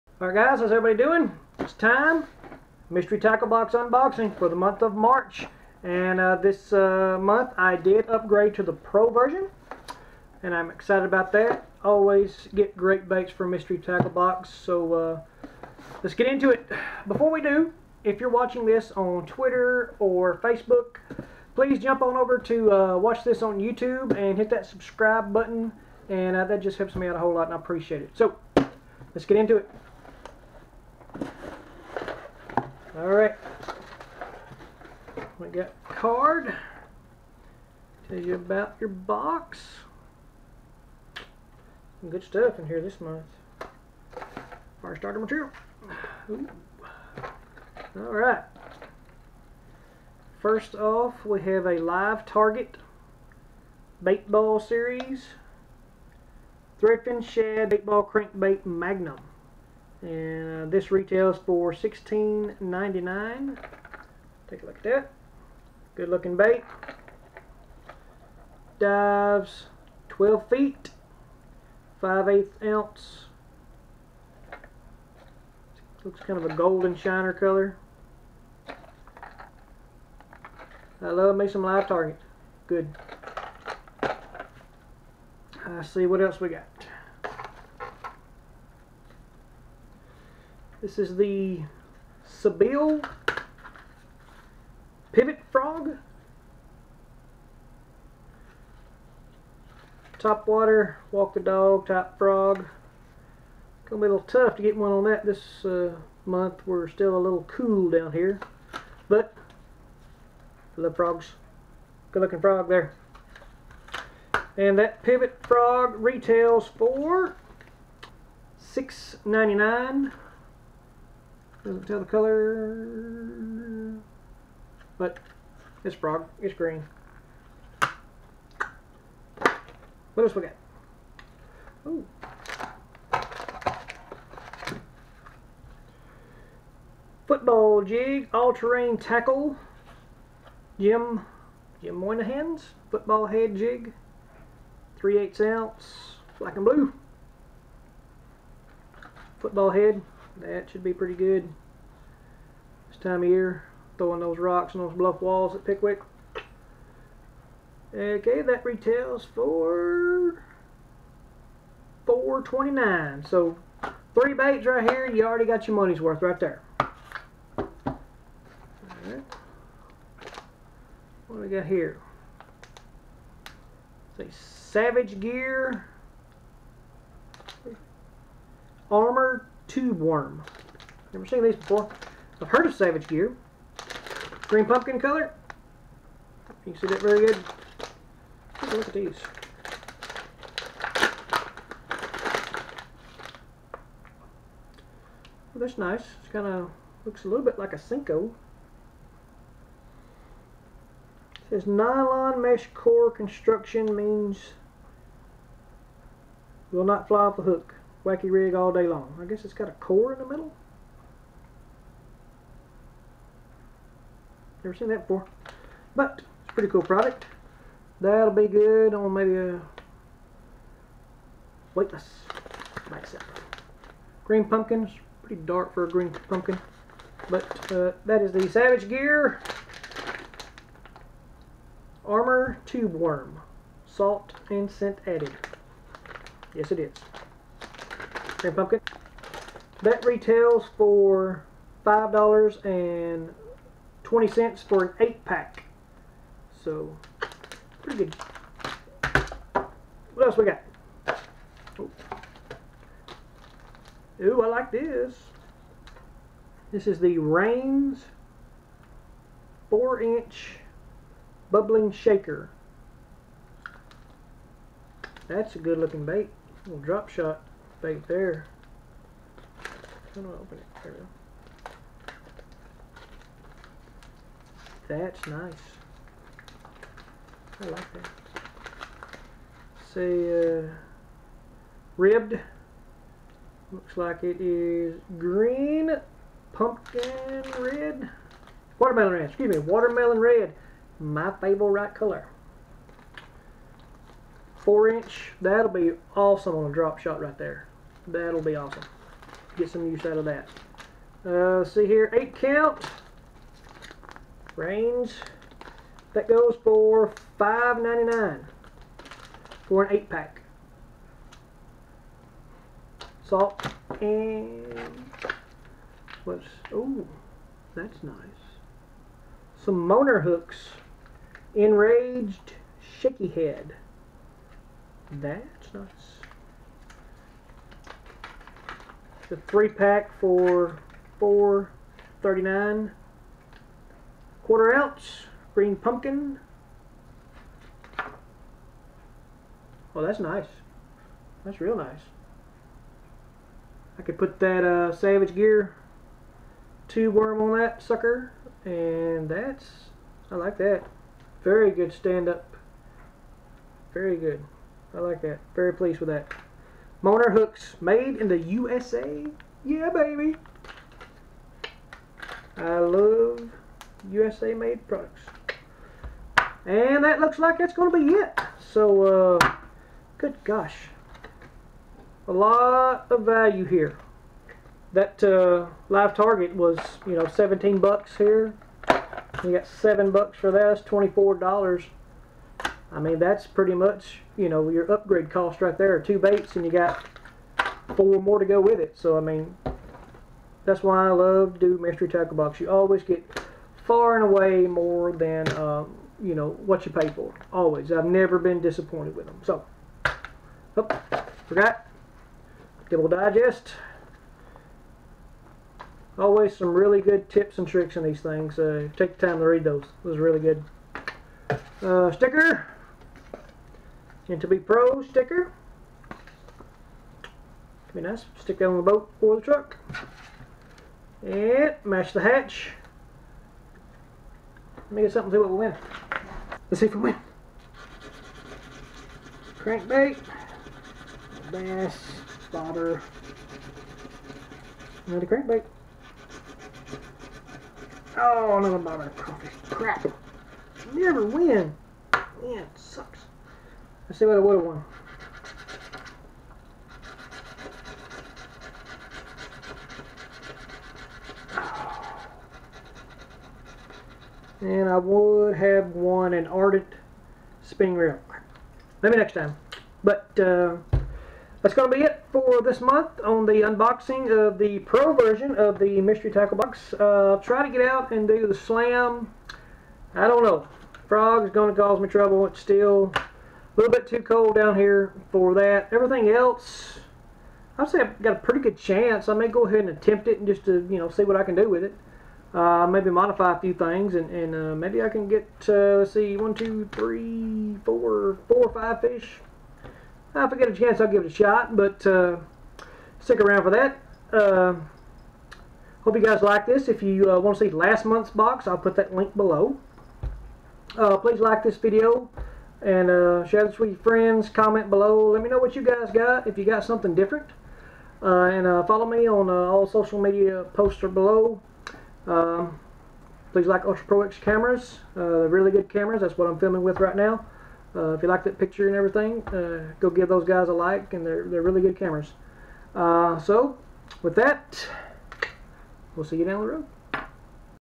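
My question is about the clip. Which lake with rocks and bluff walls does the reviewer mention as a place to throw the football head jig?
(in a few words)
Pickwick.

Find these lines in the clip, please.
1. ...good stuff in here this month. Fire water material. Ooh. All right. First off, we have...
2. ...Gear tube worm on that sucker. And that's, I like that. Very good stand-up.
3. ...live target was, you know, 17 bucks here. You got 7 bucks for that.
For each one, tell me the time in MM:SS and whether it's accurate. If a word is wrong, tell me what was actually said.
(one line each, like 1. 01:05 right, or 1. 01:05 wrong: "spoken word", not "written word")
1. 00:42 wrong: "starter", not "water"
2. 05:45 right
3. 06:15 right.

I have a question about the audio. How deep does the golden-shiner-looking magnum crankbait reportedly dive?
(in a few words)
12 feet.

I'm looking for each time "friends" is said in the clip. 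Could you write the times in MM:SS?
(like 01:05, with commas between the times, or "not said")
08:23.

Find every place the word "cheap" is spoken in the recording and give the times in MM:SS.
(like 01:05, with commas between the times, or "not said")
not said.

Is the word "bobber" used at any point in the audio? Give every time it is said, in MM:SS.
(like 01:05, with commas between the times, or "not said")
07:12, 07:18.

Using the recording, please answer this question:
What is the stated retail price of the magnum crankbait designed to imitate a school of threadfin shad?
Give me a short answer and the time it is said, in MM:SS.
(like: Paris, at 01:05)
$16.99, at 01:01.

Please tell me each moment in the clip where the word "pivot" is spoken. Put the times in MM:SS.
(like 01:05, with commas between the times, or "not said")
01:35, 01:55.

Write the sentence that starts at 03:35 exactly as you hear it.
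But it's a pretty cool product.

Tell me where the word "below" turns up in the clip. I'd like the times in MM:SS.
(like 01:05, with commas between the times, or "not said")
08:19, 08:24, 08:31.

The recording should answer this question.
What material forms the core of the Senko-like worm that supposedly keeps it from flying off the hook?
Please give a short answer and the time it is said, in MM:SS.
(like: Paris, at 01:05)
Nylon mesh, at 03:21.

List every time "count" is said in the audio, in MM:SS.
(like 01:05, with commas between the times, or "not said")
05:02.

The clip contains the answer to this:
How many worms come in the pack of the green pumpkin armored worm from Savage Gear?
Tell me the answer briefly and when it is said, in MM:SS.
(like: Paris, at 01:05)
8, at 04:04.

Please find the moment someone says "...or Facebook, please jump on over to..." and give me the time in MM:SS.
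00:19.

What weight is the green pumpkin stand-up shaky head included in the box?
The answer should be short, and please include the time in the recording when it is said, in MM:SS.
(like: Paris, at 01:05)
Quarter ounce, at 05:34.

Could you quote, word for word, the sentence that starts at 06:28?
So, I mean, that's why I love to do Mystery Tackle Box.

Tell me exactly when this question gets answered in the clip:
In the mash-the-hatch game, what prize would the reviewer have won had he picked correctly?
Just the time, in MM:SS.
07:36.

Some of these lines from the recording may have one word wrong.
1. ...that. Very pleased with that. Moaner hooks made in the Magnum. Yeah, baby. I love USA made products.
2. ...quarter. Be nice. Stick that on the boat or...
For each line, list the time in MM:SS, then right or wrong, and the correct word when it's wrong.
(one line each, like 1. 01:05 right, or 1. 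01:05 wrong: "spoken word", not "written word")
1. 05:55 wrong: "USA", not "Magnum"
2. 06:55 wrong: "sticker", not "quarter".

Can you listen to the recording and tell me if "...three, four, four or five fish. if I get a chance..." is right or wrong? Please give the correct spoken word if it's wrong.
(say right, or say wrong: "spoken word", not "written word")
right.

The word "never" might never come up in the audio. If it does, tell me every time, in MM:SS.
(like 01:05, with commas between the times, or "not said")
03:01, 03:34, 06:38, 07:20.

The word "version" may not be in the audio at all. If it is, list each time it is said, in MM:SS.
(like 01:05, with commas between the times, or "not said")
00:09, 07:45.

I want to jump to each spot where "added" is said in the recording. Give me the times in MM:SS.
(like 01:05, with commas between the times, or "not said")
03:55.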